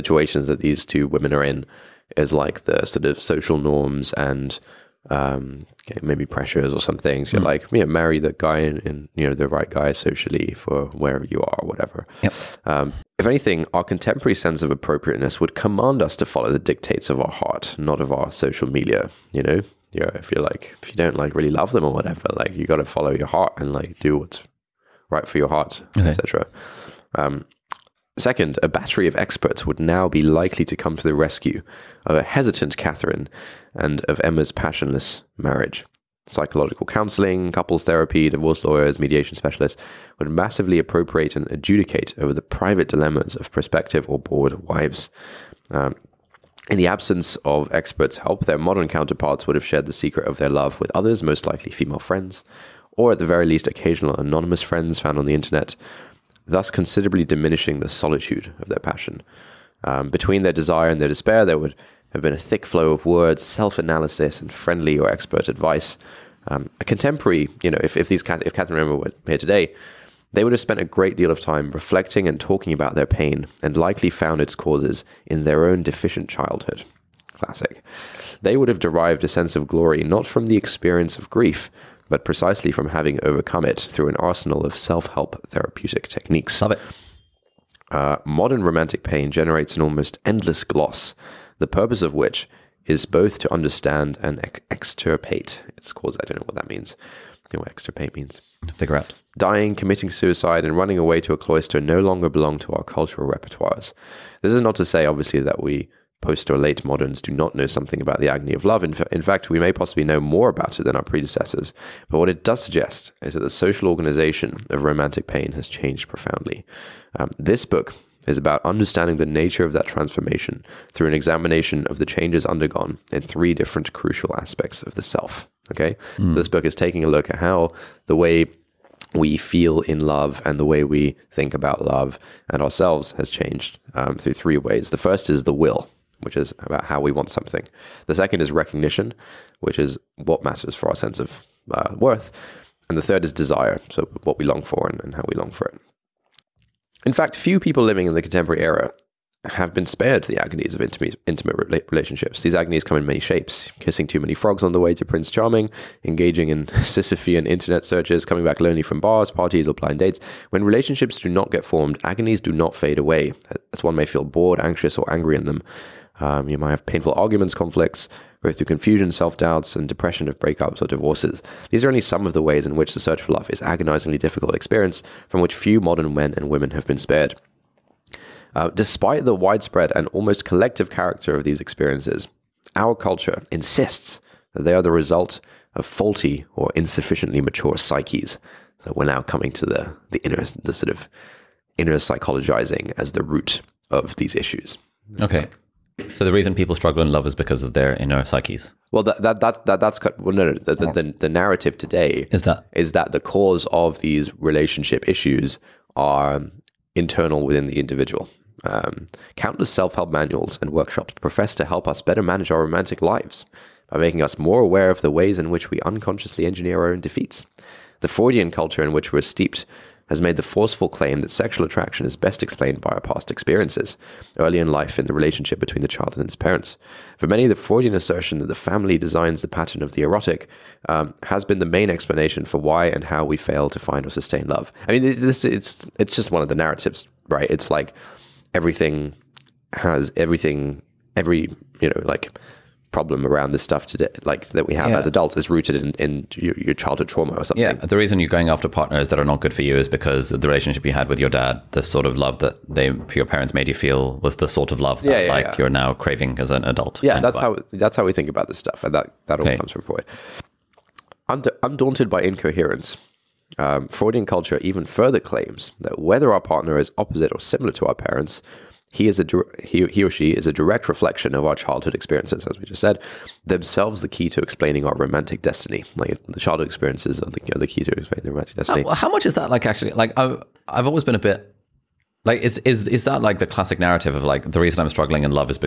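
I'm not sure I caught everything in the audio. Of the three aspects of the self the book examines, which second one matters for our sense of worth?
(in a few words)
Recognition.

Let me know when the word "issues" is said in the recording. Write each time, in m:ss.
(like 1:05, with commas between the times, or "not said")
3:14, 3:25.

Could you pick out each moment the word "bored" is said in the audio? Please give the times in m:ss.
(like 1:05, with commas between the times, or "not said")
0:44, 2:44.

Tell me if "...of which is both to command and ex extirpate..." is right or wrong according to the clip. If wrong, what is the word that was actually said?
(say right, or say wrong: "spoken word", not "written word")
wrong: "understand", not "command".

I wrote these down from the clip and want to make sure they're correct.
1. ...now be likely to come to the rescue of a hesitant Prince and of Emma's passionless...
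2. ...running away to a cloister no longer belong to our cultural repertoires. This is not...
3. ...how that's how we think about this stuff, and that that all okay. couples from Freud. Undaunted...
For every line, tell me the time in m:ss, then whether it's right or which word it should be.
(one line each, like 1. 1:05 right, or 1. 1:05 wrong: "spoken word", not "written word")
1. 0:29 wrong: "Catherine", not "Prince"
2. 1:40 right
3. 4:17 wrong: "comes", not "couples".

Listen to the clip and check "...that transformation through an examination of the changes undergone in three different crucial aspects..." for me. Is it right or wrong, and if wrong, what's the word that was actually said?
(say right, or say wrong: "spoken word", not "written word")
right.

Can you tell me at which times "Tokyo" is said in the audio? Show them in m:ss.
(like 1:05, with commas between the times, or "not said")
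not said.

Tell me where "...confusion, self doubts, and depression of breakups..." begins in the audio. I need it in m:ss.
2:48.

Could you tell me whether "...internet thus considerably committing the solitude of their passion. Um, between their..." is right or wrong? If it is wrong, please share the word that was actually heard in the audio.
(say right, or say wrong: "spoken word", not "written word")
wrong: "diminishing", not "committing".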